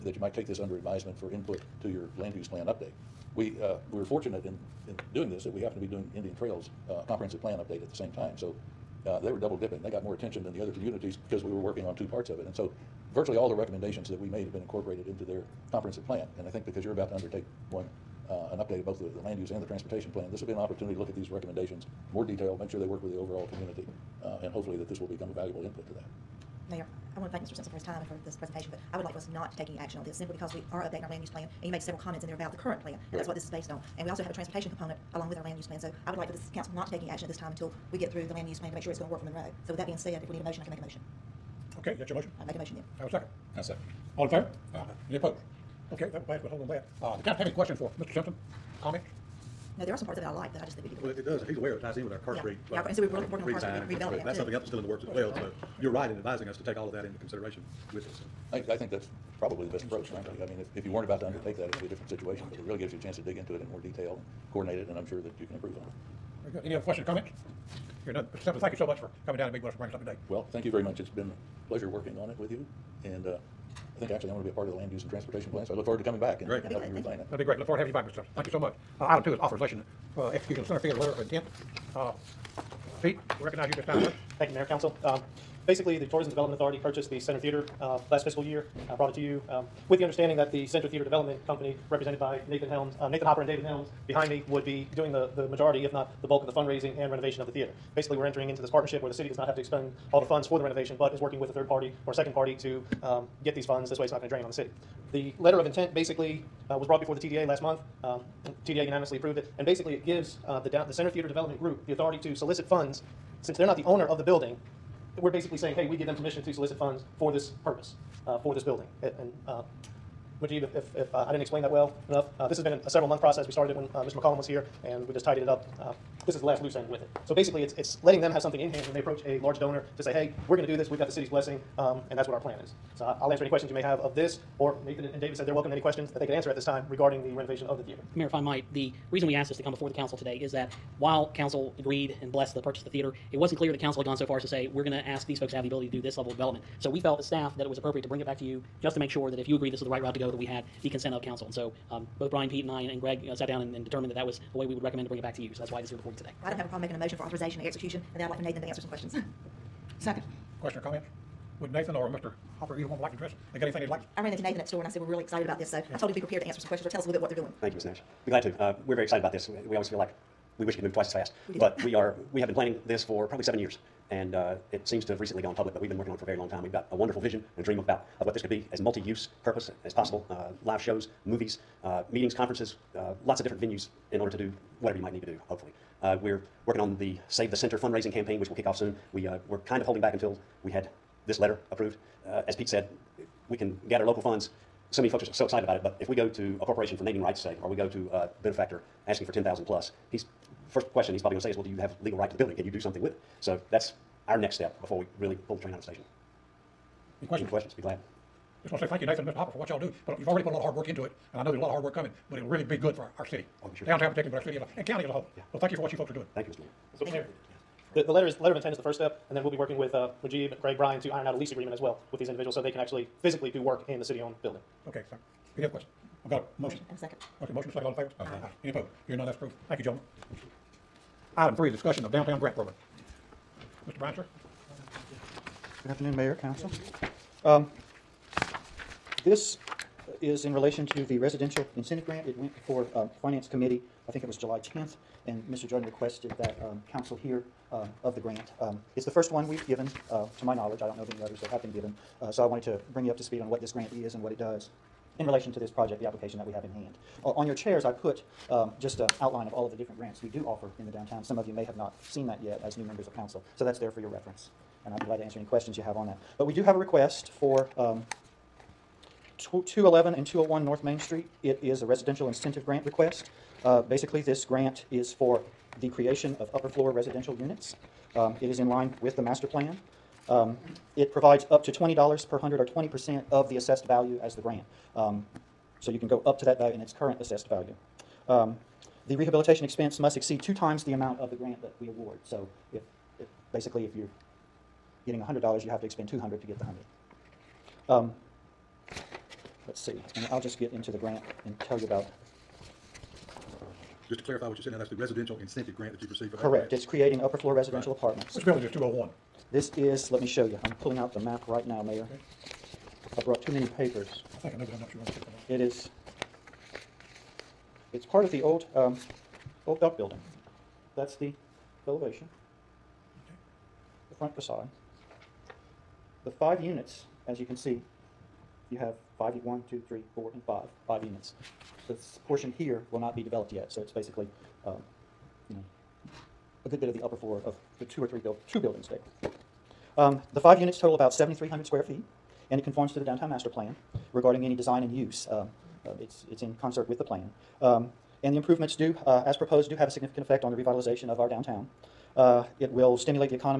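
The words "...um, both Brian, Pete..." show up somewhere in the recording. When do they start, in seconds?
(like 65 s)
151 s.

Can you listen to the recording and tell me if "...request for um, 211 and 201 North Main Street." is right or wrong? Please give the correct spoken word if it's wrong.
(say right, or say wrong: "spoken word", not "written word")
right.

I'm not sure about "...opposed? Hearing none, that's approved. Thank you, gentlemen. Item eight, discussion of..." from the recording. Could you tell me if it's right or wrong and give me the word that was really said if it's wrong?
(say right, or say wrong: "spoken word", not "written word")
wrong: "three", not "eight".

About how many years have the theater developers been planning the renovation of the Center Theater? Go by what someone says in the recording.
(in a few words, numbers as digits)
7 years.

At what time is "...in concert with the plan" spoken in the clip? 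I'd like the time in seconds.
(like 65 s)
346 s.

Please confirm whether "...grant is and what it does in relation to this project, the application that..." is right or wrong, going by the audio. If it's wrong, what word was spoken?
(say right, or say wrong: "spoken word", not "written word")
right.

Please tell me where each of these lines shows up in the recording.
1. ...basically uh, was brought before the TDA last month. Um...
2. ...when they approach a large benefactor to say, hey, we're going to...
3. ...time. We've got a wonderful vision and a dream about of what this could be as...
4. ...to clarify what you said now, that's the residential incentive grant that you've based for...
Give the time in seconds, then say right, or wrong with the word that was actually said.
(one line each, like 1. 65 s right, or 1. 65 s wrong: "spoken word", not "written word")
1. 105 s right
2. 128 s wrong: "donor", not "benefactor"
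3. 176 s right
4. 304 s wrong: "received", not "based".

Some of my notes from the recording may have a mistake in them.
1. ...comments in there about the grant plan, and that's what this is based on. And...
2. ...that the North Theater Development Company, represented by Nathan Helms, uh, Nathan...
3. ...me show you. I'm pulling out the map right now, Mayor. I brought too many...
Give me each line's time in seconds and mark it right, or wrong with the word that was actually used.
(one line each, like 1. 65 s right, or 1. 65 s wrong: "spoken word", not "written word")
1. 31 s wrong: "current", not "grant"
2. 90 s wrong: "Center", not "North"
3. 310 s right.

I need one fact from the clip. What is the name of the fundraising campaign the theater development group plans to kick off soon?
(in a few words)
Save the Center.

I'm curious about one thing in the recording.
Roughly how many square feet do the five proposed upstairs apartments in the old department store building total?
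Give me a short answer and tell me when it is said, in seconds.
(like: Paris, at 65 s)
7,300, at 341 s.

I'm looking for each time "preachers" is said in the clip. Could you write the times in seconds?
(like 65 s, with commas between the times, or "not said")
not said.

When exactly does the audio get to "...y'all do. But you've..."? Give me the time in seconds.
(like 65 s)
209 s.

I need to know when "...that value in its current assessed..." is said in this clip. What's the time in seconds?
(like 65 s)
286 s.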